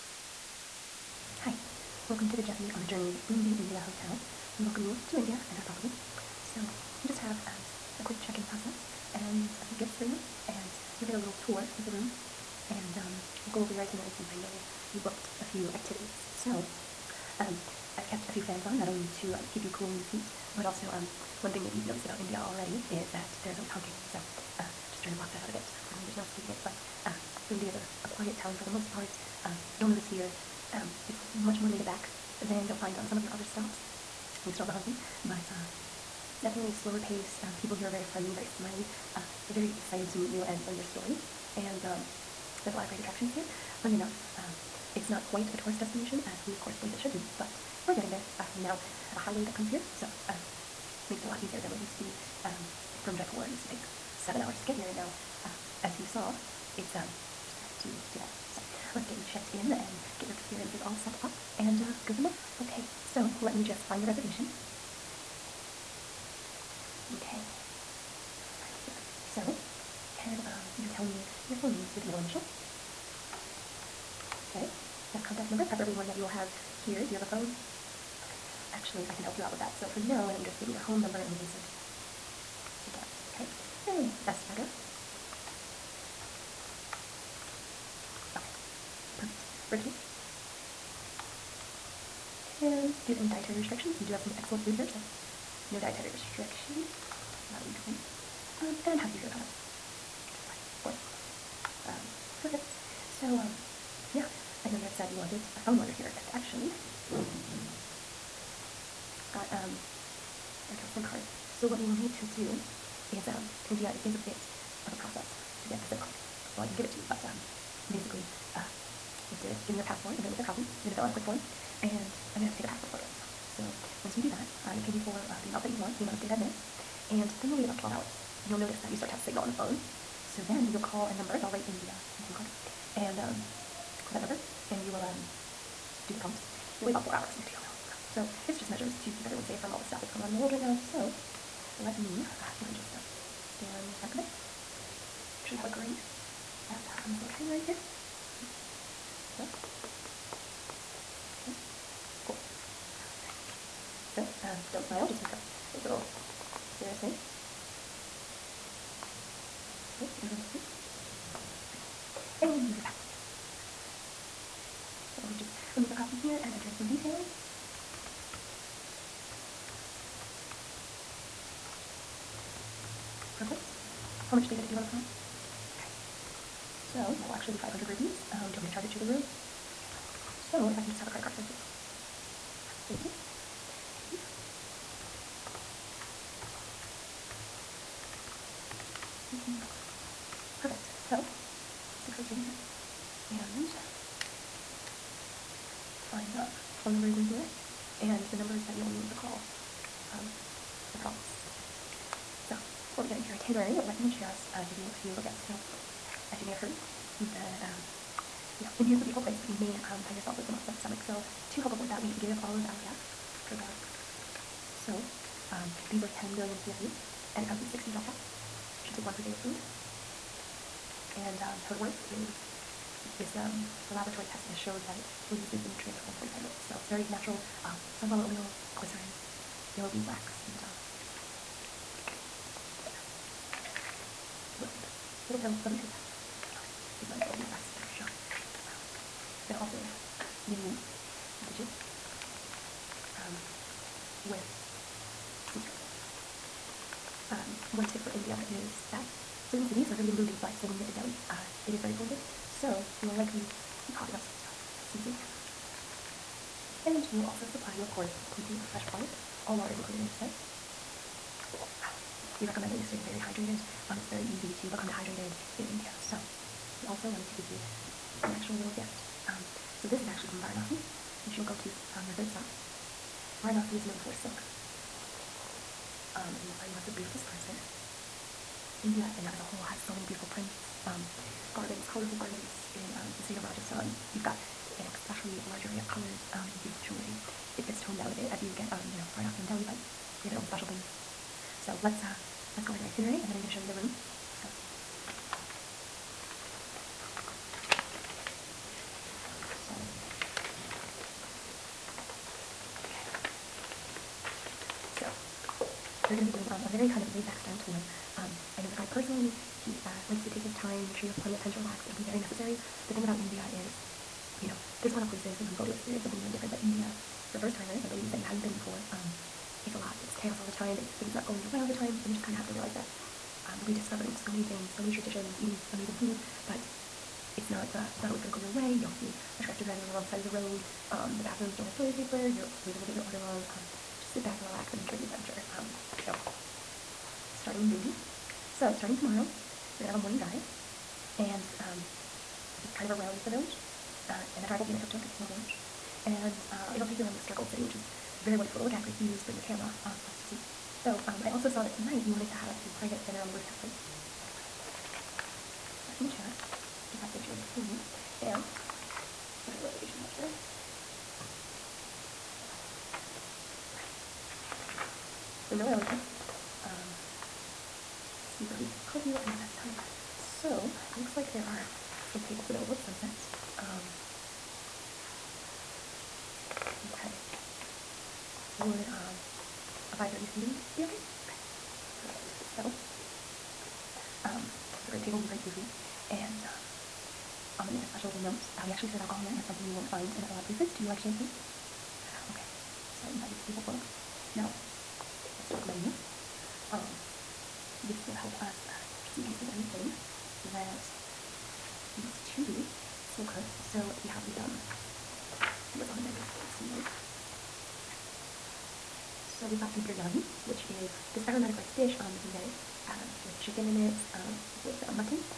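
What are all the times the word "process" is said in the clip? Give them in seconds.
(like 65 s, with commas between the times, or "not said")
8 s, 114 s.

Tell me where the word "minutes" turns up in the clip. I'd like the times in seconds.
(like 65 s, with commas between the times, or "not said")
126 s, 226 s.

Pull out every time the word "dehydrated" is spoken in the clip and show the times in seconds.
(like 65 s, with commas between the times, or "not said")
264 s.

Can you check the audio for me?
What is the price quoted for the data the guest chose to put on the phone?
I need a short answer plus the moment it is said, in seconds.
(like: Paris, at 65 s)
500 rupees, at 177 s.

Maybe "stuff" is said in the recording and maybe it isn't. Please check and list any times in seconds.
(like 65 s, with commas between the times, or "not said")
139 s, 254 s.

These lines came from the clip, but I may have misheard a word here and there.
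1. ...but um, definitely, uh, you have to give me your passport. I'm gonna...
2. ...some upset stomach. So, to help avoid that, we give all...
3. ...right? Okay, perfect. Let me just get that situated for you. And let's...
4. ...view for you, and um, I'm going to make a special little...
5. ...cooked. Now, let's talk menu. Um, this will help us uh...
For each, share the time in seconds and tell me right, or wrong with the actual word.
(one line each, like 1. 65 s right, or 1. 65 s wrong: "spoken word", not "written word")
1. 117 s wrong: "basically", not "definitely"
2. 210 s right
3. 353 s right
4. 385 s right
5. 393 s wrong: "booked", not "cooked".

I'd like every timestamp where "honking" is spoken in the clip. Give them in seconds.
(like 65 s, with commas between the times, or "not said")
23 s, 34 s.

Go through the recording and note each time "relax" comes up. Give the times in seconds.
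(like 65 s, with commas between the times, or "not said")
311 s, 334 s.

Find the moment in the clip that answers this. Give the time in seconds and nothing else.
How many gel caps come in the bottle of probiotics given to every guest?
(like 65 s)
217 s.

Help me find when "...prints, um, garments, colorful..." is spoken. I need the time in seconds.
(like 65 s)
280 s.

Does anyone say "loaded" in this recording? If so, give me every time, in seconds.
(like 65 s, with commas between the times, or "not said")
not said.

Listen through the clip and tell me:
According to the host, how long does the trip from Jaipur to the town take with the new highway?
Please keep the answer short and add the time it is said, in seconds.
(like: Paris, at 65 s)
2 hours, at 58 s.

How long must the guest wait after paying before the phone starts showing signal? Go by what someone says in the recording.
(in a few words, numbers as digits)
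12 hours.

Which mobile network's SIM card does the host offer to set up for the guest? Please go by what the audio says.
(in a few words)
Airtel.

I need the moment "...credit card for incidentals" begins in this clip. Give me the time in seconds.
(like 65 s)
181 s.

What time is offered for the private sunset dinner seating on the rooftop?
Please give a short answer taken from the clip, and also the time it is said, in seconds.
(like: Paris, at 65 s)
5:30, at 379 s.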